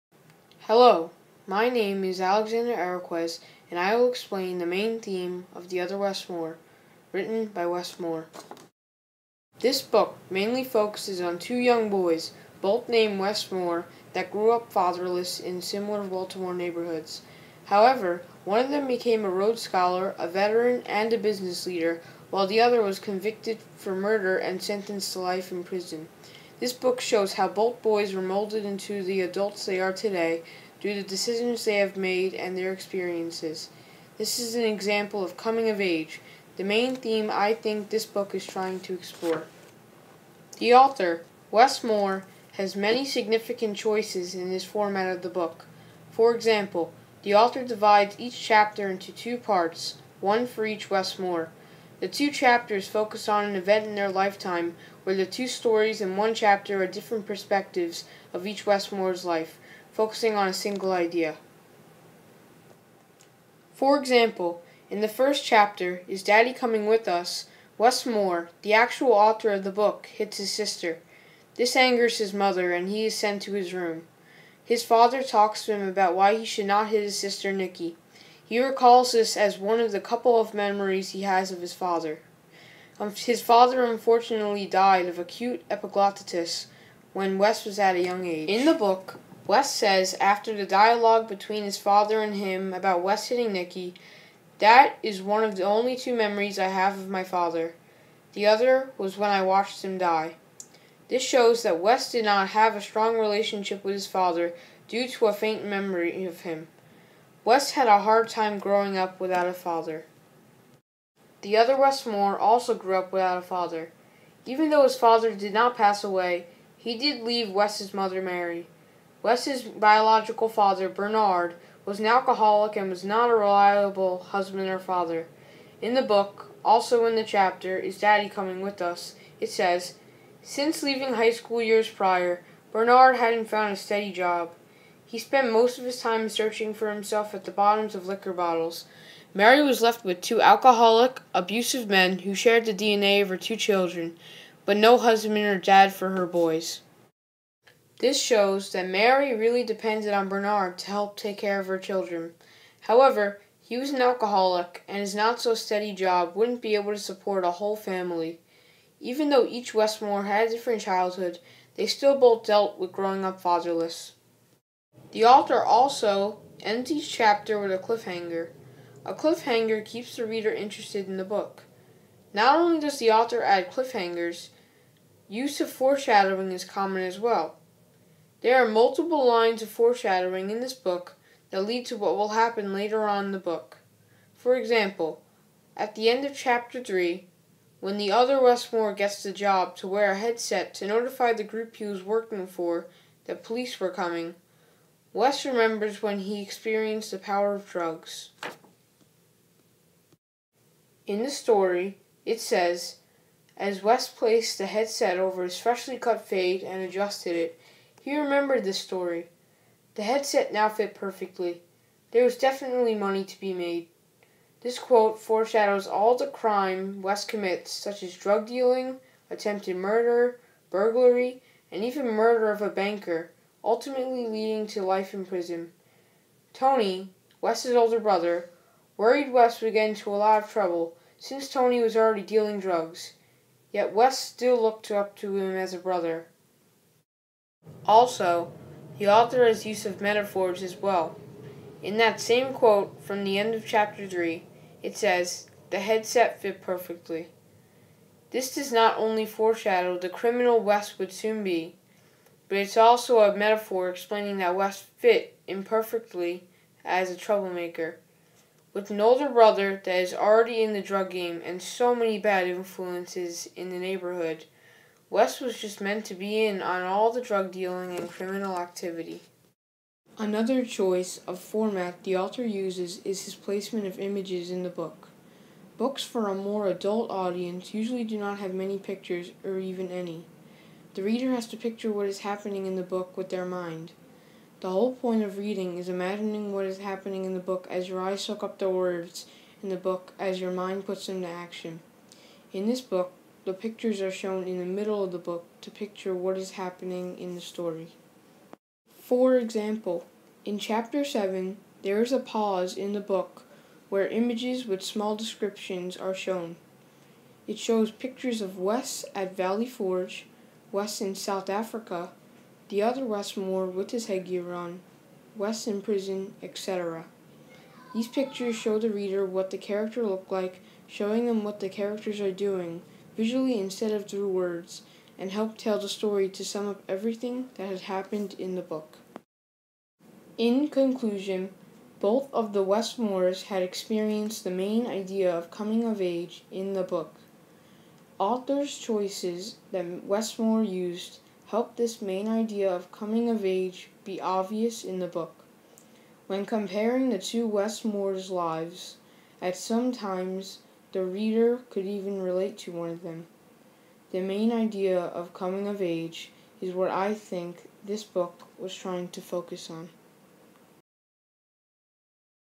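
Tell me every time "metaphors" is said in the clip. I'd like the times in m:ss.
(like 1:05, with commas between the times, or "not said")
4:00, 4:13.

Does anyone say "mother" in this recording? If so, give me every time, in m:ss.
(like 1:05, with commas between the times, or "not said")
1:12, 1:57.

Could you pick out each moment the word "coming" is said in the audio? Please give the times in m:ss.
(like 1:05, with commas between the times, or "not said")
0:35, 1:06, 2:08, 3:13, 5:35, 5:42, 5:55.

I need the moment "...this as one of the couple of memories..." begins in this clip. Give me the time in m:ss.
1:19.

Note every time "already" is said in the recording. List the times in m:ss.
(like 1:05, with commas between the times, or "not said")
3:51, 4:20.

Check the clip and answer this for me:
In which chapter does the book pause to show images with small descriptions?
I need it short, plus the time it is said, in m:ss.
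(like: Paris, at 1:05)
Chapter 7, at 5:00.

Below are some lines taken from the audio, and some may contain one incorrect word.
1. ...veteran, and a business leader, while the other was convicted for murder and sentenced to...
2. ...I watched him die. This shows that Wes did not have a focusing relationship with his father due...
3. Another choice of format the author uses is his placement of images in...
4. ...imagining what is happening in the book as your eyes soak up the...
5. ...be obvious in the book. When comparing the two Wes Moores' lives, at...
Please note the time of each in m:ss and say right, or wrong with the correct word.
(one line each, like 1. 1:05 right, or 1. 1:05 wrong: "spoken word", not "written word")
1. 0:20 right
2. 1:39 wrong: "strong", not "focusing"
3. 4:30 right
4. 4:45 right
5. 5:44 right.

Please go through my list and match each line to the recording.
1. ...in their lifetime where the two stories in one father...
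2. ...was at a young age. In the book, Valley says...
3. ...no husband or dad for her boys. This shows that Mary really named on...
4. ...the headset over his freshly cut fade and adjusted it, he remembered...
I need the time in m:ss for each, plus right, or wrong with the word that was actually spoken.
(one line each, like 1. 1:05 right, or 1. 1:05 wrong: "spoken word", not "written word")
1. 0:53 wrong: "chapter", not "father"
2. 1:27 wrong: "Wes", not "Valley"
3. 2:24 wrong: "depended", not "named"
4. 3:24 right.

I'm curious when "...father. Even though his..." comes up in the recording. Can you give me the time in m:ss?
1:53.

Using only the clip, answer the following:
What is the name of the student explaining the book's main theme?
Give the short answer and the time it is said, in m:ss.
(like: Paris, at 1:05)
Alexander Araquez, at 0:02.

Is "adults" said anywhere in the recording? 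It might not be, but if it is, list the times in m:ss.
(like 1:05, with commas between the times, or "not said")
0:29, 4:36.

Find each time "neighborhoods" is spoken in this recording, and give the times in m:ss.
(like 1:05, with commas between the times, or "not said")
0:16, 4:23.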